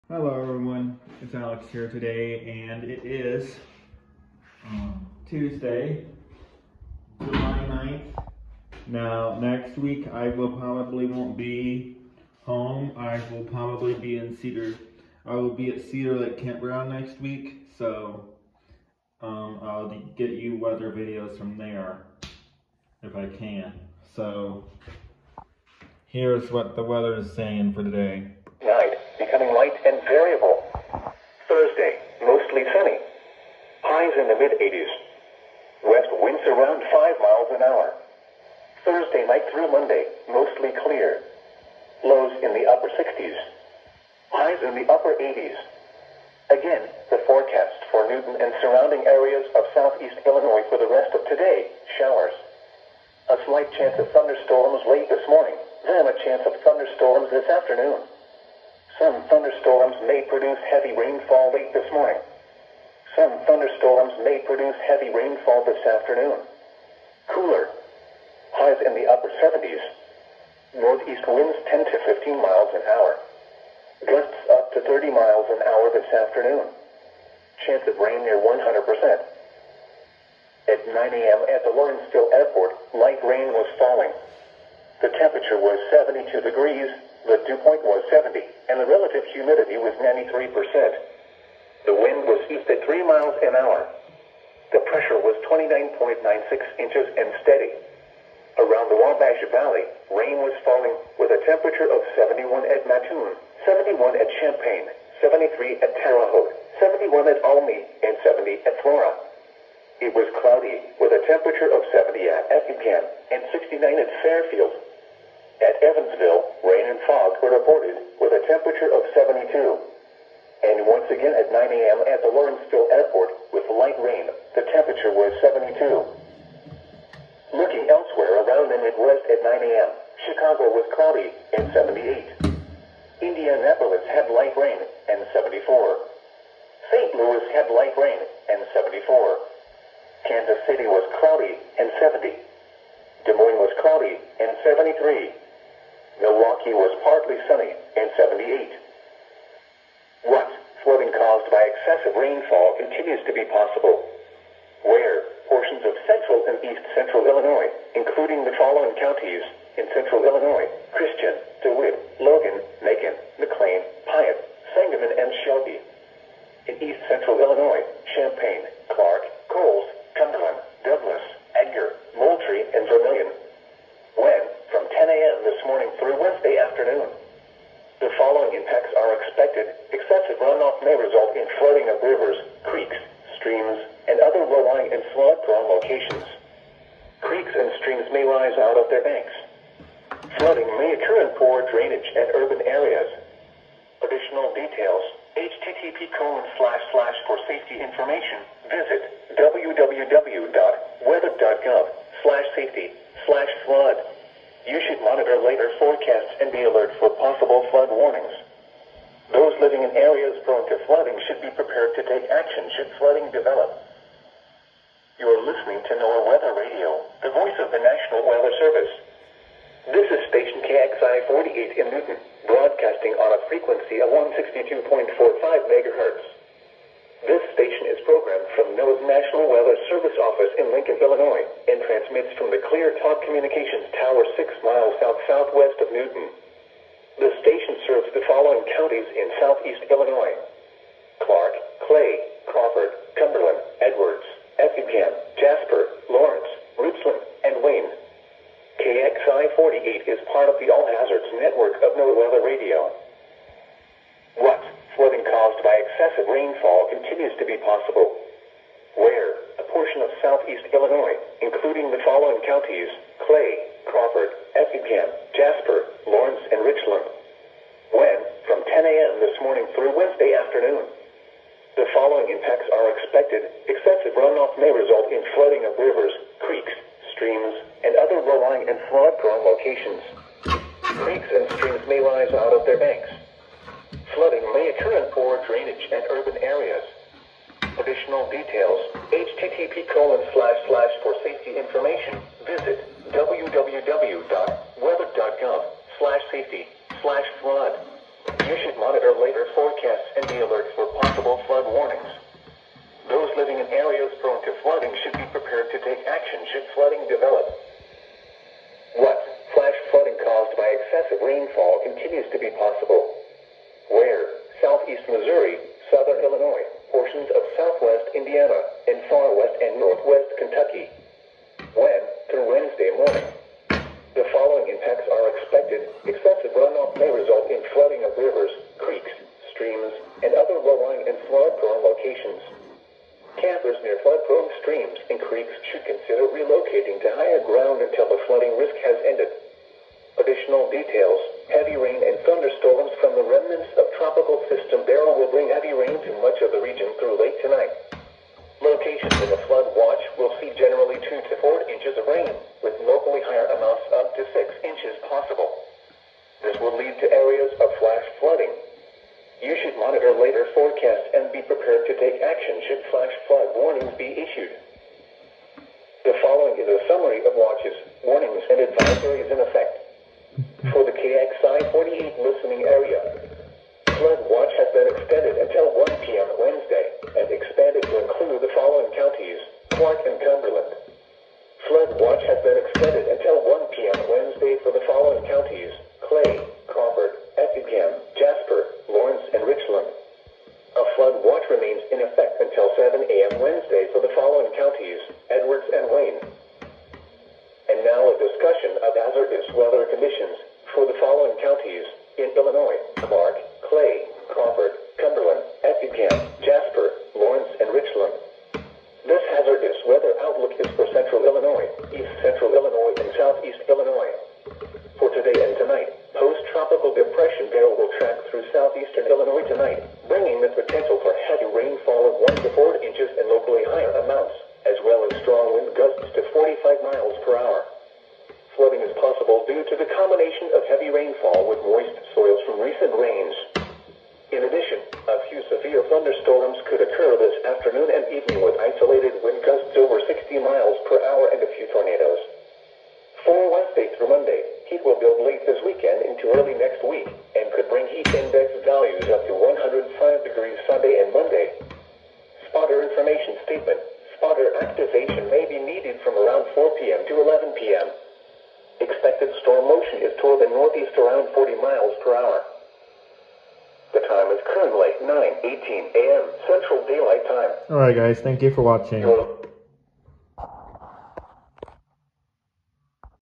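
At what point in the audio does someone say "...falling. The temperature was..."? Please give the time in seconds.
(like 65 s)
83 s.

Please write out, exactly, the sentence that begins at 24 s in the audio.
So here's what the weather is saying for today.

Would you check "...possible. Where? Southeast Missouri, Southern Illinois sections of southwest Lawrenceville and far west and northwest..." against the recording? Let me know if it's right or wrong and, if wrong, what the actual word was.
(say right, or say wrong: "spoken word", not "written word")
wrong: "Indiana", not "Lawrenceville".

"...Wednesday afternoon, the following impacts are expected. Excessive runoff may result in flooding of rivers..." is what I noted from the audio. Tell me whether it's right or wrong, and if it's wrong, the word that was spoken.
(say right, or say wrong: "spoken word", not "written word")
right.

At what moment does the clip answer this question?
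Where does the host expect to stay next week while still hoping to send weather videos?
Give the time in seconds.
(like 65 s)
15 s.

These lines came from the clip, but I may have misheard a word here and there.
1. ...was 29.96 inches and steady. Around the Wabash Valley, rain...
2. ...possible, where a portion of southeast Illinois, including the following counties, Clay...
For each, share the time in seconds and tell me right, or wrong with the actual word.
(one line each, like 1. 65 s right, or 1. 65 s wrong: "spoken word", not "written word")
1. 95 s right
2. 257 s right.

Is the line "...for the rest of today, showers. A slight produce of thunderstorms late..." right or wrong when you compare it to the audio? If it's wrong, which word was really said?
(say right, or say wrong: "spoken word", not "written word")
wrong: "chance", not "produce".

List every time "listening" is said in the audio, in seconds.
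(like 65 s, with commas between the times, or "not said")
215 s.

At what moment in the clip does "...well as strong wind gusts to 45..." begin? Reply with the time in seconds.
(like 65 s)
424 s.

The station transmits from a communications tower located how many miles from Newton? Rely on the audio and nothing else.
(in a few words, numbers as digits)
6 miles.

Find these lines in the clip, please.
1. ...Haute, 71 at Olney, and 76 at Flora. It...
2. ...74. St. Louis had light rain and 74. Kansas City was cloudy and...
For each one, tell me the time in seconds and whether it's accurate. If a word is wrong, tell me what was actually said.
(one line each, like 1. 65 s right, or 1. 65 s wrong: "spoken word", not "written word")
1. 106 s wrong: "70", not "76"
2. 135 s right.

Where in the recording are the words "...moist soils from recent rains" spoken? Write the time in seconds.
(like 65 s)
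431 s.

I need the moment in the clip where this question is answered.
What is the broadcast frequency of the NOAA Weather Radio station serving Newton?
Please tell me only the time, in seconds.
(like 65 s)
224 s.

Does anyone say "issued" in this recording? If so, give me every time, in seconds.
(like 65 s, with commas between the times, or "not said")
364 s.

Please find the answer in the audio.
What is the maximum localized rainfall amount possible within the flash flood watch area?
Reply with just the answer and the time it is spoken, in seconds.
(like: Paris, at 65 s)
6 inches, at 354 s.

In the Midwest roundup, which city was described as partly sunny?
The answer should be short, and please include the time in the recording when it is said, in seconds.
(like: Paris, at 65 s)
Milwaukee, at 146 s.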